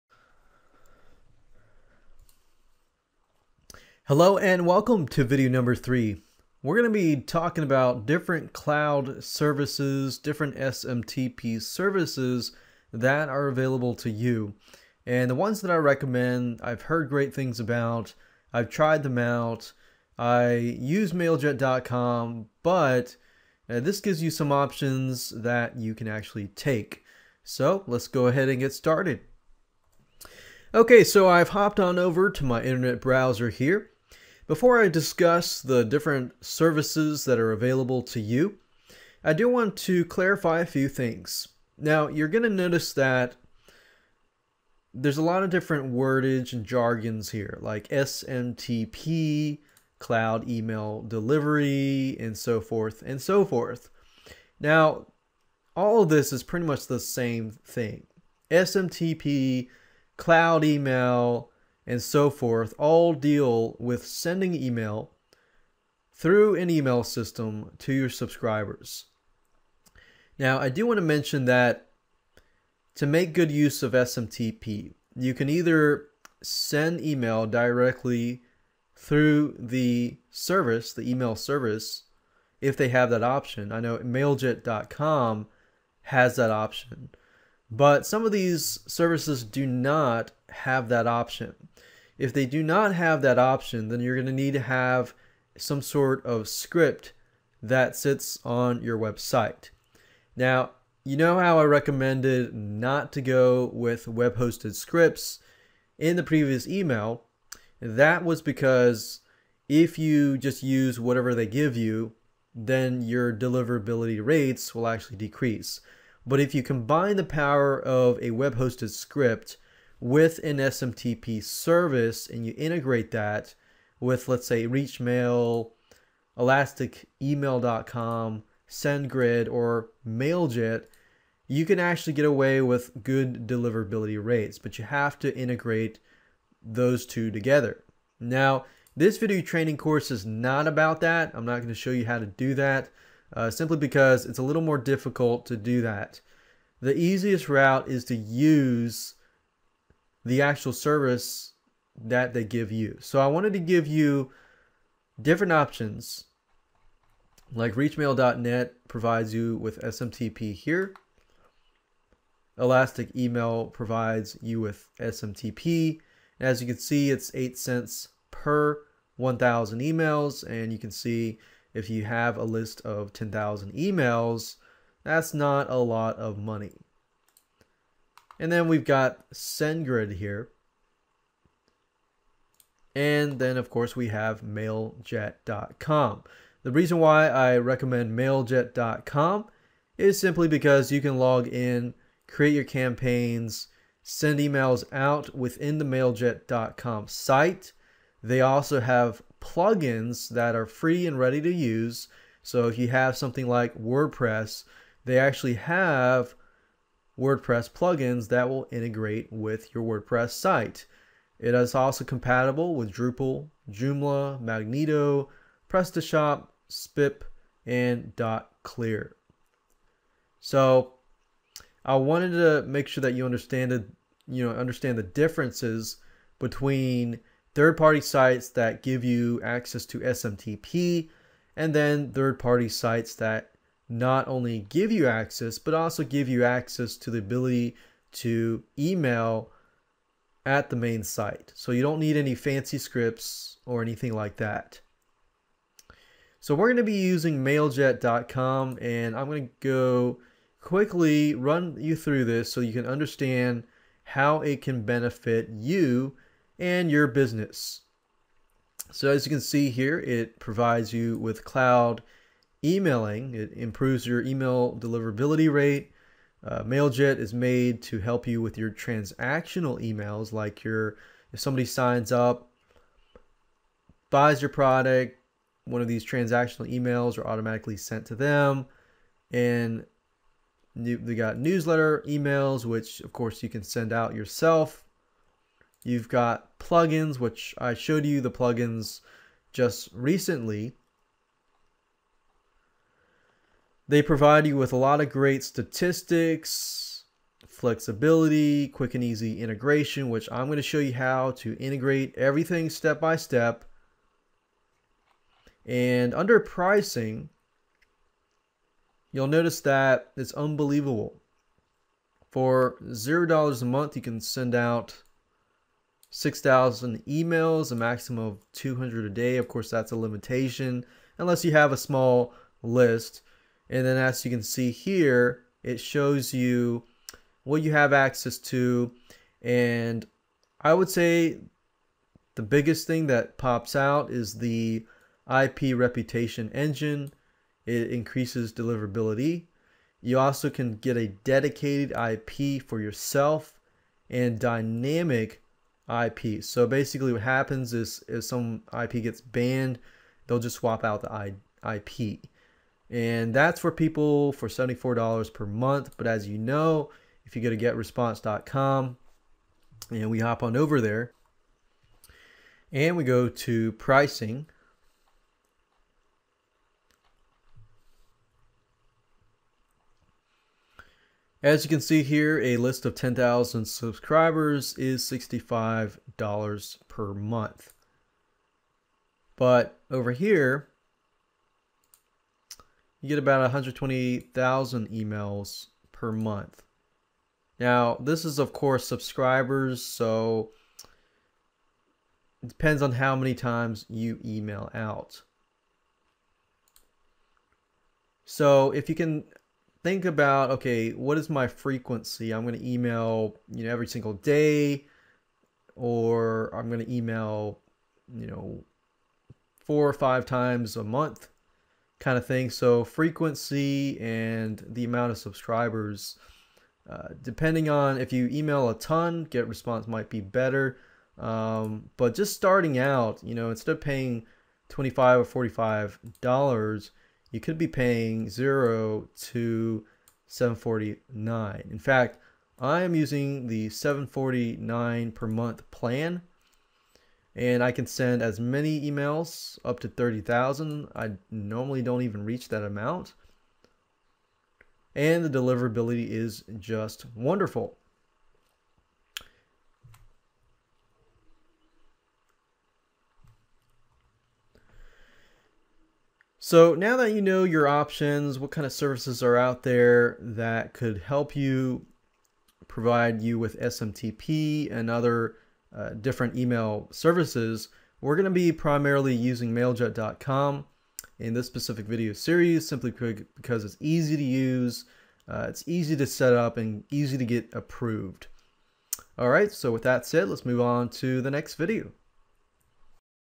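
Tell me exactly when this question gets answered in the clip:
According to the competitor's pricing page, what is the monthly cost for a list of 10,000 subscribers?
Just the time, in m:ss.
6:15.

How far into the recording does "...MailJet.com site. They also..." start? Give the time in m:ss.
3:15.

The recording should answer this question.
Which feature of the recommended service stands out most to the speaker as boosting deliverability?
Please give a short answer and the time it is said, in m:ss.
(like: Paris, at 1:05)
IP reputation engine, at 5:35.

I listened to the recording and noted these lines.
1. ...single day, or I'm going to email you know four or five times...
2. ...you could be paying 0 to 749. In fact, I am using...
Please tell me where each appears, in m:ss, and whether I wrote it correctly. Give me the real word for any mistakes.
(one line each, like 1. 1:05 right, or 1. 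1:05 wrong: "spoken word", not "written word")
1. 6:43 right
2. 7:07 right.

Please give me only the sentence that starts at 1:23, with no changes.
I know mailjet.com has that option.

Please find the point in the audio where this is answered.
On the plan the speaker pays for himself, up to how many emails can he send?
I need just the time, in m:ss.
7:19.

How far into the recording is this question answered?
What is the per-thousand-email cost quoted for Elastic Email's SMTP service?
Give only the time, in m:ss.
2:47.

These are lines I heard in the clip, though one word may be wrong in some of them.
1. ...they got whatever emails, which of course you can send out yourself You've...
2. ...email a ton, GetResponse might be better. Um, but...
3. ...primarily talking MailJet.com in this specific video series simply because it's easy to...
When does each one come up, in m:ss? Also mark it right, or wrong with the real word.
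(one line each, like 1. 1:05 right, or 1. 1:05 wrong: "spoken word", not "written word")
1. 4:40 wrong: "newsletter", not "whatever"
2. 6:58 right
3. 7:48 wrong: "using", not "talking".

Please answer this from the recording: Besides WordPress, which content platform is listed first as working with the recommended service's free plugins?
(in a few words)
Drupal.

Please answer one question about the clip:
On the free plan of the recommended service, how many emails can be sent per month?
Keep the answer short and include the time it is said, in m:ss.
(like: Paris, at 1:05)
6,000, at 5:16.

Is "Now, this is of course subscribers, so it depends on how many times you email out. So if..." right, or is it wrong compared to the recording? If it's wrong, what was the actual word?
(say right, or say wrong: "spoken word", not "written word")
right.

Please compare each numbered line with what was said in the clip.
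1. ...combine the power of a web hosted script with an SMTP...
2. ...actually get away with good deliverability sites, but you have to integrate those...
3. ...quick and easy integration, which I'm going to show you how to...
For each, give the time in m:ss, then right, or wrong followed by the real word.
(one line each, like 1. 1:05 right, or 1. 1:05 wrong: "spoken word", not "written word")
1. 1:56 right
2. 2:11 wrong: "rates", not "sites"
3. 4:58 right.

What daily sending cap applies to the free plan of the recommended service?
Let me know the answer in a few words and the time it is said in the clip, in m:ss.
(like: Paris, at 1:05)
200, at 5:18.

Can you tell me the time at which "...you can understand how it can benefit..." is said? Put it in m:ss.
4:12.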